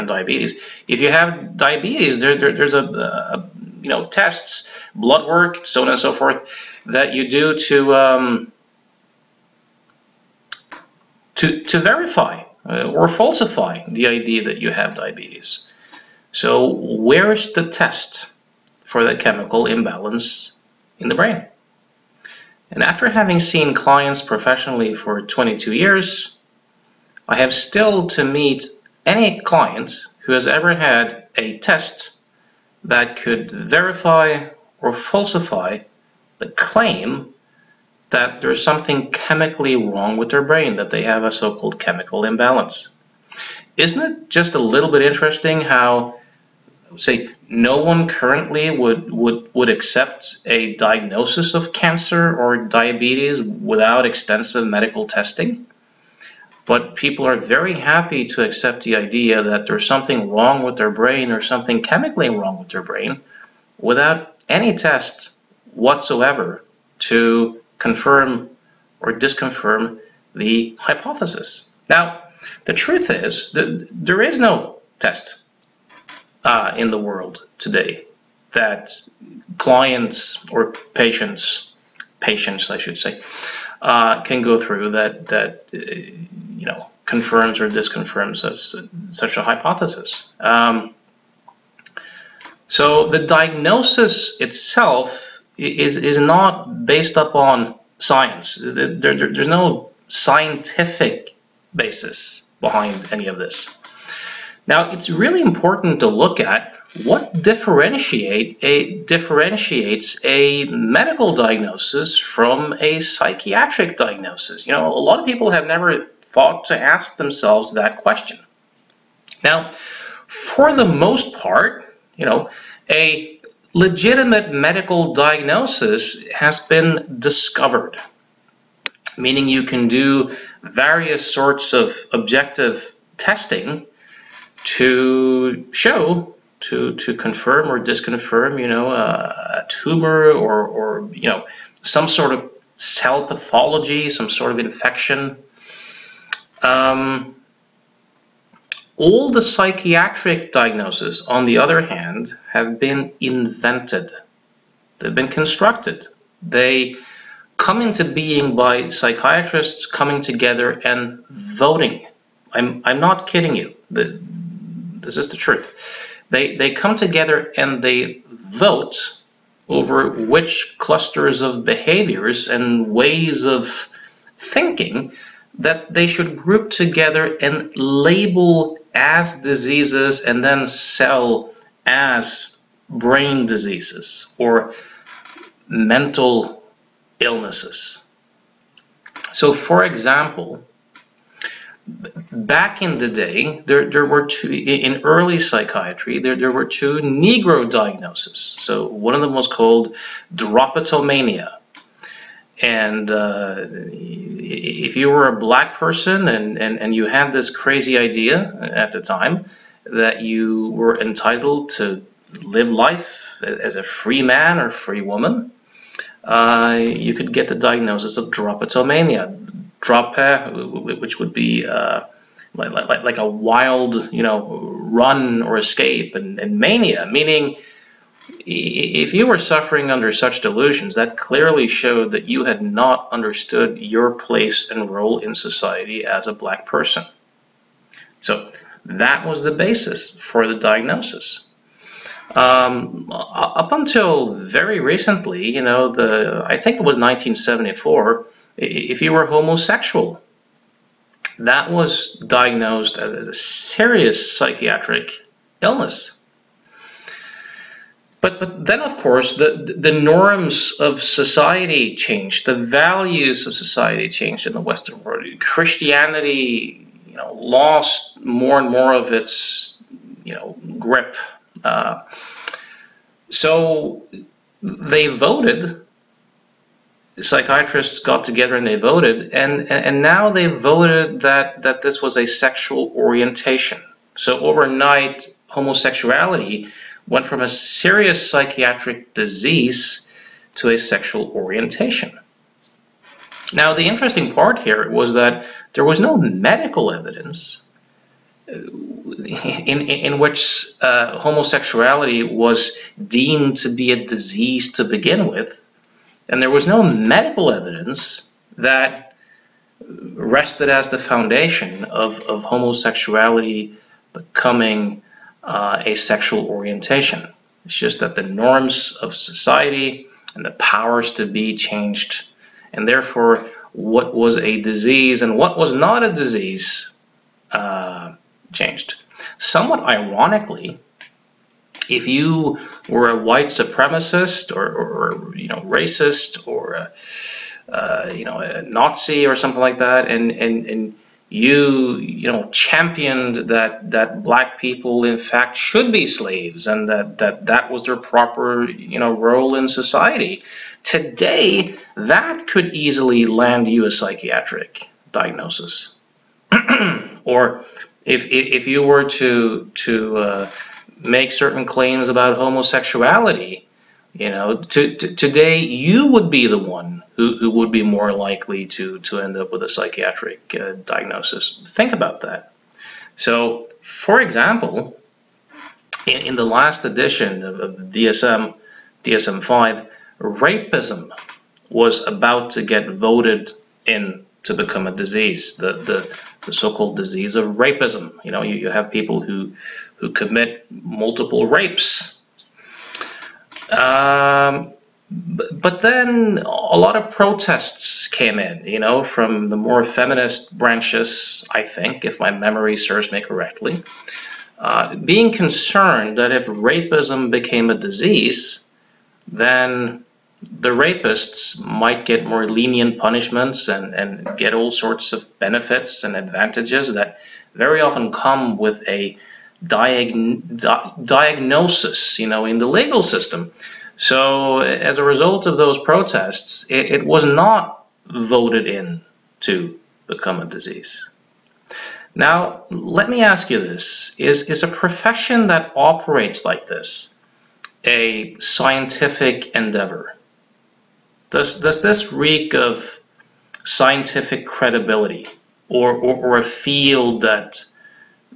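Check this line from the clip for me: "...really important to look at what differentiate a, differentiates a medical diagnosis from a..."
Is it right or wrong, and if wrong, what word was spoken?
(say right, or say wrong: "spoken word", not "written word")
right.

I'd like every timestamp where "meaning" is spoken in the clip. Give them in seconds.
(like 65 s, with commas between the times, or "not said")
129 s, 227 s.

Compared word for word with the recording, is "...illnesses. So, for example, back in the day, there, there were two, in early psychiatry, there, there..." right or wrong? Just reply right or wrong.
right.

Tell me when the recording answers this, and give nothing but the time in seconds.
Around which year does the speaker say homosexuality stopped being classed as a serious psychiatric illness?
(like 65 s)
246 s.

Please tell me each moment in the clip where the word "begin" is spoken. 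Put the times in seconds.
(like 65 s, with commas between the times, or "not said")
304 s.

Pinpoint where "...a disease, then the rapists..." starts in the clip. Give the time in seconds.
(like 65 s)
407 s.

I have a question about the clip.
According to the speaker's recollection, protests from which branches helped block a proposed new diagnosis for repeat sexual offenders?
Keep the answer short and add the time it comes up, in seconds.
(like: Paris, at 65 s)
feminist branches, at 399 s.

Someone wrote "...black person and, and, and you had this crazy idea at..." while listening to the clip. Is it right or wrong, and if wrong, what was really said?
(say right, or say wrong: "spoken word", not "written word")
right.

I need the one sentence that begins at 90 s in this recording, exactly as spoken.
Um, so the diagnosis itself is is not based upon science.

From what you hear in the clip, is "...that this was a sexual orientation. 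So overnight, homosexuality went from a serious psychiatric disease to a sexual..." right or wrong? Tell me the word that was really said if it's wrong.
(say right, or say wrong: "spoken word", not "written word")
right.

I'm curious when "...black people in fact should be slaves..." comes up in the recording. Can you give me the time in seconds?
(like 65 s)
344 s.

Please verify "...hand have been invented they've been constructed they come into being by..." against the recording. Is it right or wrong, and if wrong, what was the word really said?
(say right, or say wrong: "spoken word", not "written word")
right.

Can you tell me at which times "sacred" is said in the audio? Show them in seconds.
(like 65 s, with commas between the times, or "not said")
not said.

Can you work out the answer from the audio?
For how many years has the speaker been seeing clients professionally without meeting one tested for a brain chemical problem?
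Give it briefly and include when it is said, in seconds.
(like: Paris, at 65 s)
22 years, at 25 s.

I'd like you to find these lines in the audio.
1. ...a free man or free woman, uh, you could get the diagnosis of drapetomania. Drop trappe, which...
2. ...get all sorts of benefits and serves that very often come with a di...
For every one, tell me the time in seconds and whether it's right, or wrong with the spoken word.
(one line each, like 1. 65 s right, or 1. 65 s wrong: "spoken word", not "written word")
1. 213 s right
2. 414 s wrong: "advantages", not "serves".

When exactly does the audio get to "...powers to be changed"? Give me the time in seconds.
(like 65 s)
320 s.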